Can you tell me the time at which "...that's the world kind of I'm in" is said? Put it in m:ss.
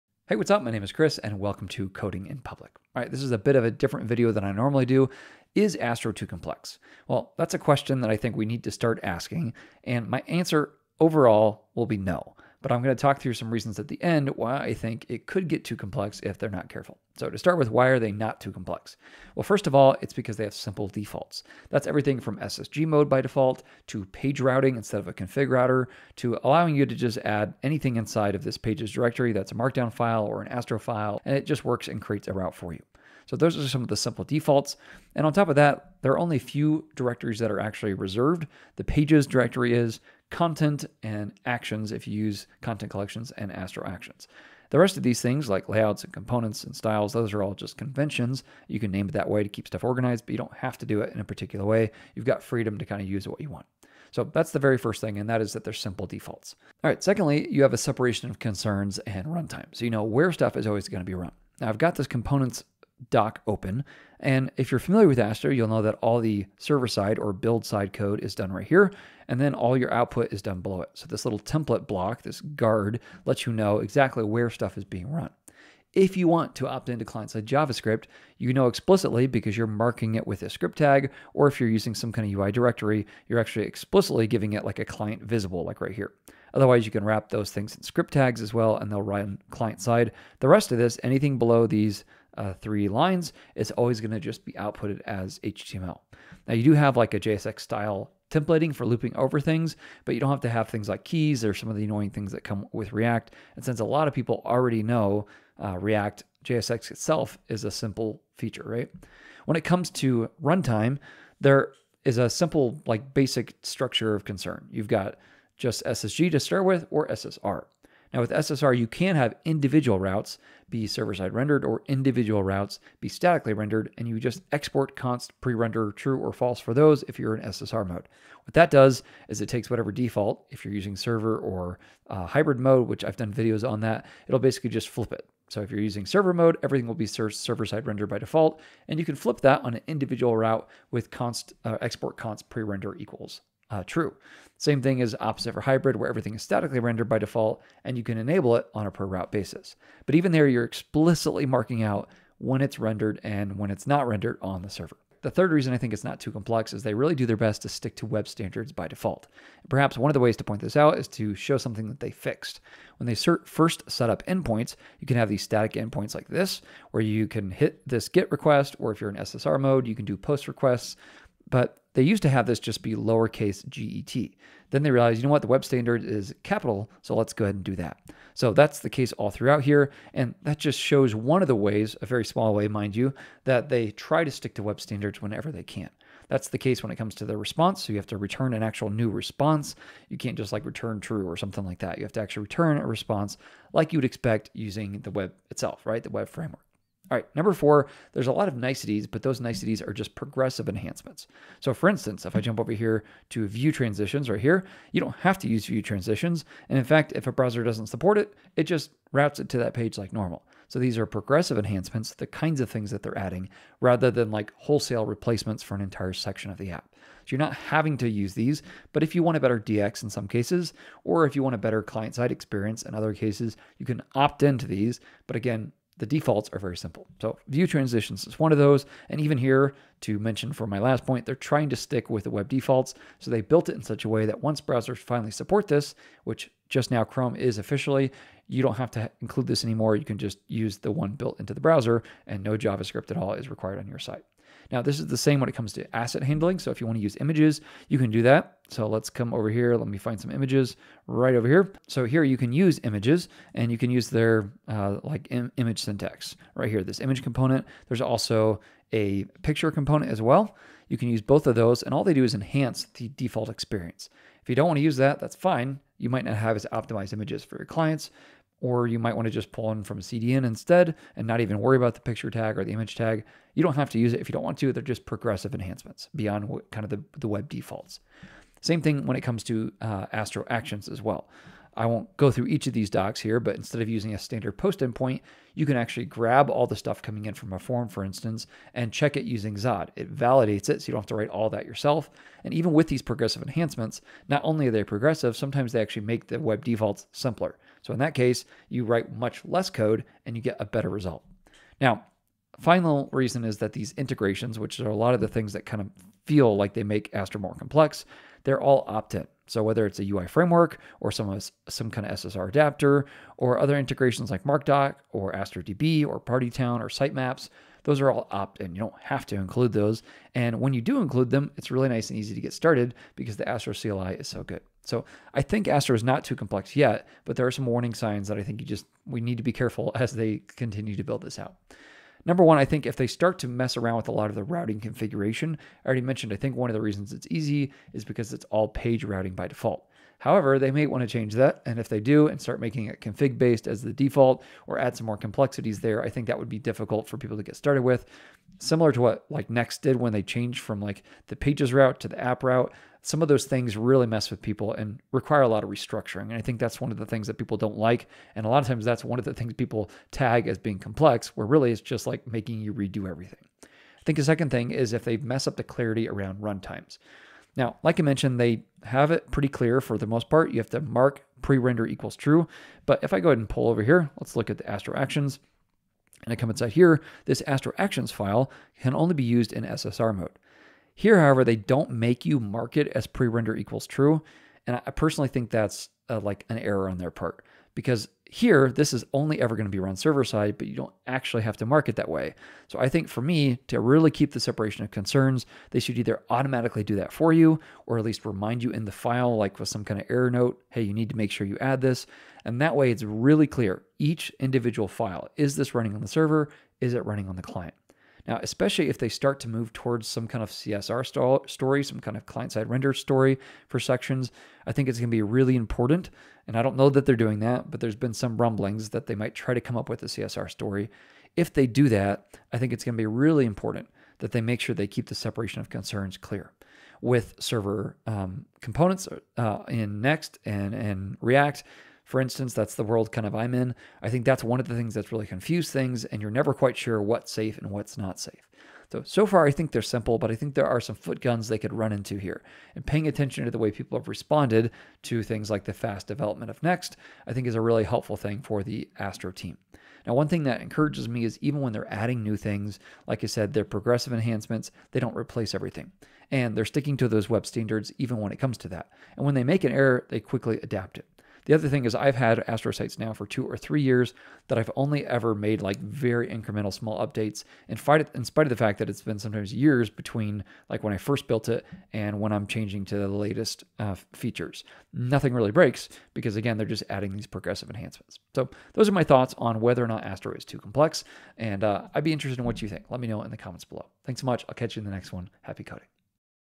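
7:12.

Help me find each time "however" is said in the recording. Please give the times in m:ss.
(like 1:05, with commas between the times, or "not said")
5:40, 6:21.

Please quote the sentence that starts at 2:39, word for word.
Perhaps one of the ways to point this out is to show something that they fixed.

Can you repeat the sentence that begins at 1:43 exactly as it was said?
And since a lot of people already know uh, React, JSX itself is a simple feature, right?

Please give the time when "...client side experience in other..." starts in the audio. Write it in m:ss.
3:41.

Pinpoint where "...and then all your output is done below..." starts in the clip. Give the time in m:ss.
1:09.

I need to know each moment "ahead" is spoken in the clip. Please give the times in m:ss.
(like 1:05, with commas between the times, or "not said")
2:57, 6:13.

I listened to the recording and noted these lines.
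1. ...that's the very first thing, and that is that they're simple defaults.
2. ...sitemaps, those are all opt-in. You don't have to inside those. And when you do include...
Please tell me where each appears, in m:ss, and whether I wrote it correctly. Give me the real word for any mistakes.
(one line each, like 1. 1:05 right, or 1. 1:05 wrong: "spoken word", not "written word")
1. 0:54 right
2. 5:16 wrong: "include", not "inside".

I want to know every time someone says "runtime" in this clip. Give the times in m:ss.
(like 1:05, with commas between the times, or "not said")
0:59, 1:50, 6:06.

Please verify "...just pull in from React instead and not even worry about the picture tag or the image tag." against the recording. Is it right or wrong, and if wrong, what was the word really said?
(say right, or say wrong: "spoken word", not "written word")
wrong: "CDN", not "React".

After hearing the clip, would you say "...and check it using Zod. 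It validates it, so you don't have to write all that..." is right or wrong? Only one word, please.
right.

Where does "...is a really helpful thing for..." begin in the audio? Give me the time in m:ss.
7:27.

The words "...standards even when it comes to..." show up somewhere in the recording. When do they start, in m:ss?
7:37.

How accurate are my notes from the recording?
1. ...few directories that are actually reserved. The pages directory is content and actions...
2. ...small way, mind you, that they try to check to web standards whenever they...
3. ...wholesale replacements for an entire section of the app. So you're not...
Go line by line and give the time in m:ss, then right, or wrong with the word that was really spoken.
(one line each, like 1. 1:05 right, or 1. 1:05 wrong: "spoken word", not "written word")
1. 0:36 right
2. 3:02 wrong: "stick", not "check"
3. 3:34 right.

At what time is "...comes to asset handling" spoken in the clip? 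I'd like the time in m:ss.
4:05.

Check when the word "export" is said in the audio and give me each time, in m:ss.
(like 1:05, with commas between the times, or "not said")
2:04, 2:21.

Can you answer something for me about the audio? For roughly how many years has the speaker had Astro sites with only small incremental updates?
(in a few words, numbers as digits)
2 or 3 years.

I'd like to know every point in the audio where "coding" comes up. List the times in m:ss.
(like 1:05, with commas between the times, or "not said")
0:01, 8:05.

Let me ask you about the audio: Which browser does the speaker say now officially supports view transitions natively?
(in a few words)
Chrome.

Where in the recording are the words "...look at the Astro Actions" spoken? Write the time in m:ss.
6:14.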